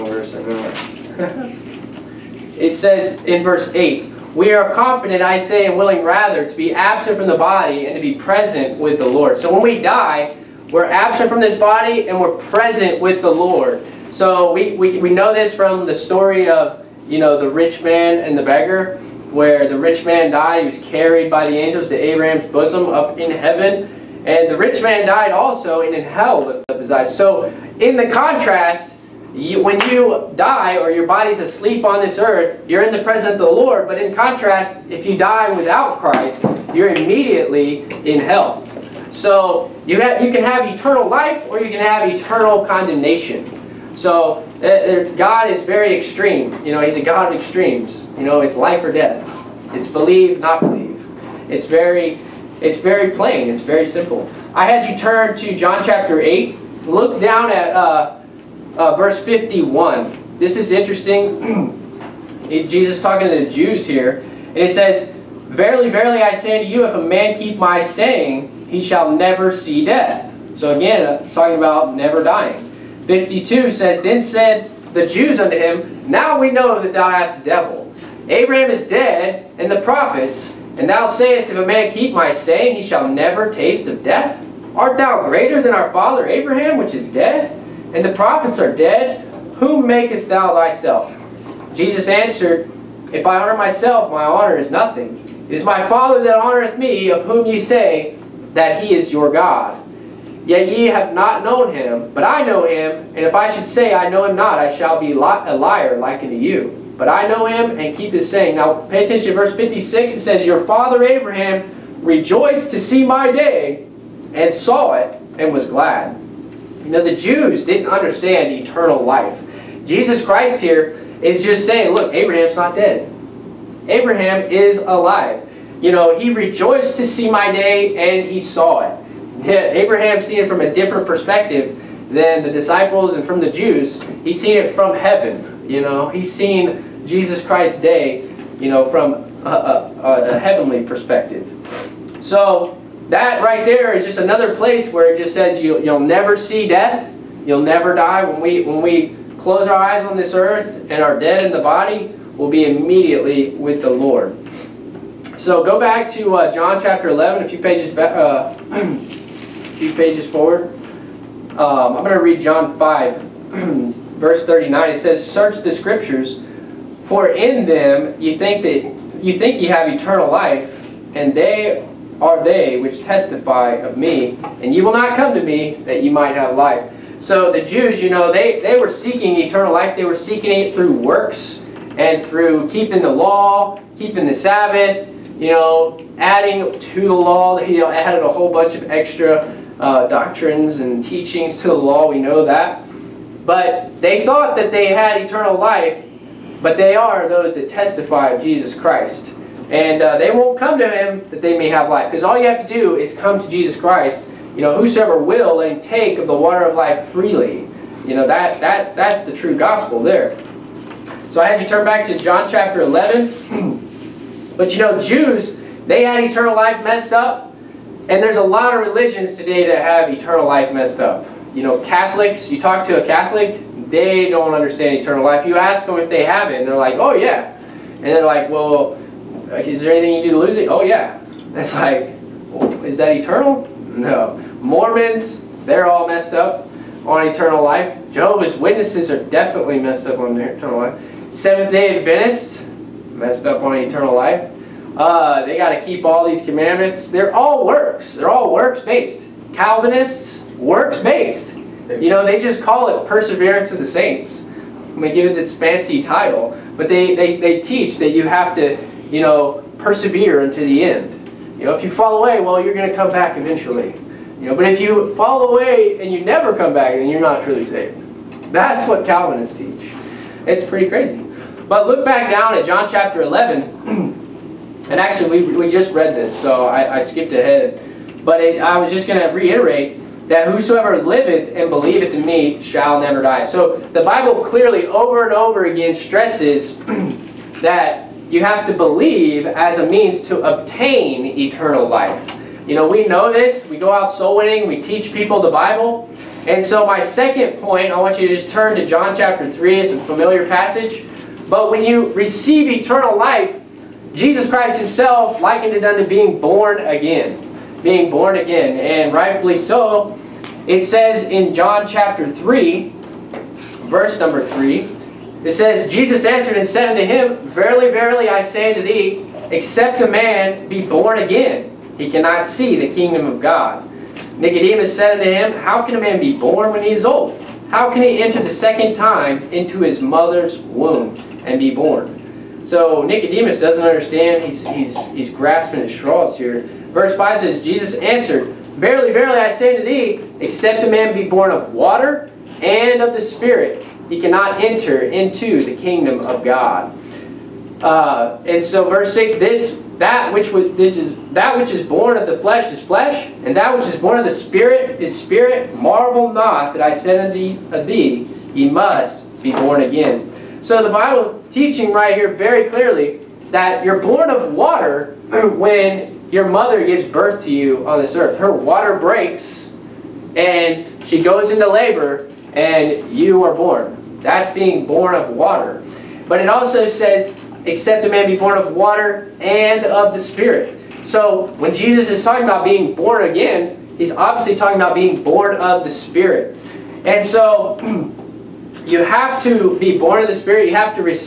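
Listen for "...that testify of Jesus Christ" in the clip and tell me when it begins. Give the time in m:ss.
3:17.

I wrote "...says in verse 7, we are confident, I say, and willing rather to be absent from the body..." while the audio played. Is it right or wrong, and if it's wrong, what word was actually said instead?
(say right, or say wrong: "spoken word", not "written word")
wrong: "8", not "7".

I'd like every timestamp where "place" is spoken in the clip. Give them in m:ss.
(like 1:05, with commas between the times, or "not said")
2:24.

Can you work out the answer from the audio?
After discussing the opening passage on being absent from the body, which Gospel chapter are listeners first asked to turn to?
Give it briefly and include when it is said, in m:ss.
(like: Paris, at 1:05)
John chapter 8, at 0:55.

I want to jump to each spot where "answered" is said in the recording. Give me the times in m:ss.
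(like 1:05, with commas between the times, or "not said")
1:32, 5:16, 5:37.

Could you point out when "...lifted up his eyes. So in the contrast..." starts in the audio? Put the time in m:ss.
0:26.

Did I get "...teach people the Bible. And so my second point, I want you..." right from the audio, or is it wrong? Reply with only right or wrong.
right.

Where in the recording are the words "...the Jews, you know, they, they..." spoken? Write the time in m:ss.
2:57.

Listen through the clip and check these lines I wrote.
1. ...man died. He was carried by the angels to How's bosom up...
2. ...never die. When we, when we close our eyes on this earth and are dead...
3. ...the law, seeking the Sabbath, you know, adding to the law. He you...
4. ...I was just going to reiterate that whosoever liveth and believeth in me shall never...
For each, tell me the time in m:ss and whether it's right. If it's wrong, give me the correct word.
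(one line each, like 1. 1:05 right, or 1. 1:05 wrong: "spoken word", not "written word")
1. 0:20 wrong: "Abraham", not "How"
2. 2:27 right
3. 3:03 wrong: "keeping", not "seeking"
4. 4:38 right.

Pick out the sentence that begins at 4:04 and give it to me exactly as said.
Uh, they got to keep all these commandments.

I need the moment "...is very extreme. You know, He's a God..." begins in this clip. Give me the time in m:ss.
0:45.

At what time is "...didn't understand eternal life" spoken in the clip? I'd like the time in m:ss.
1:57.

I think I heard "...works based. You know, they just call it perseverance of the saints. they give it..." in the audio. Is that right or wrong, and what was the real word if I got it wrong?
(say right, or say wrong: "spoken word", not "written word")
right.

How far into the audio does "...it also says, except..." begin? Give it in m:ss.
6:16.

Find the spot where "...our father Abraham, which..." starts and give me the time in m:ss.
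1:25.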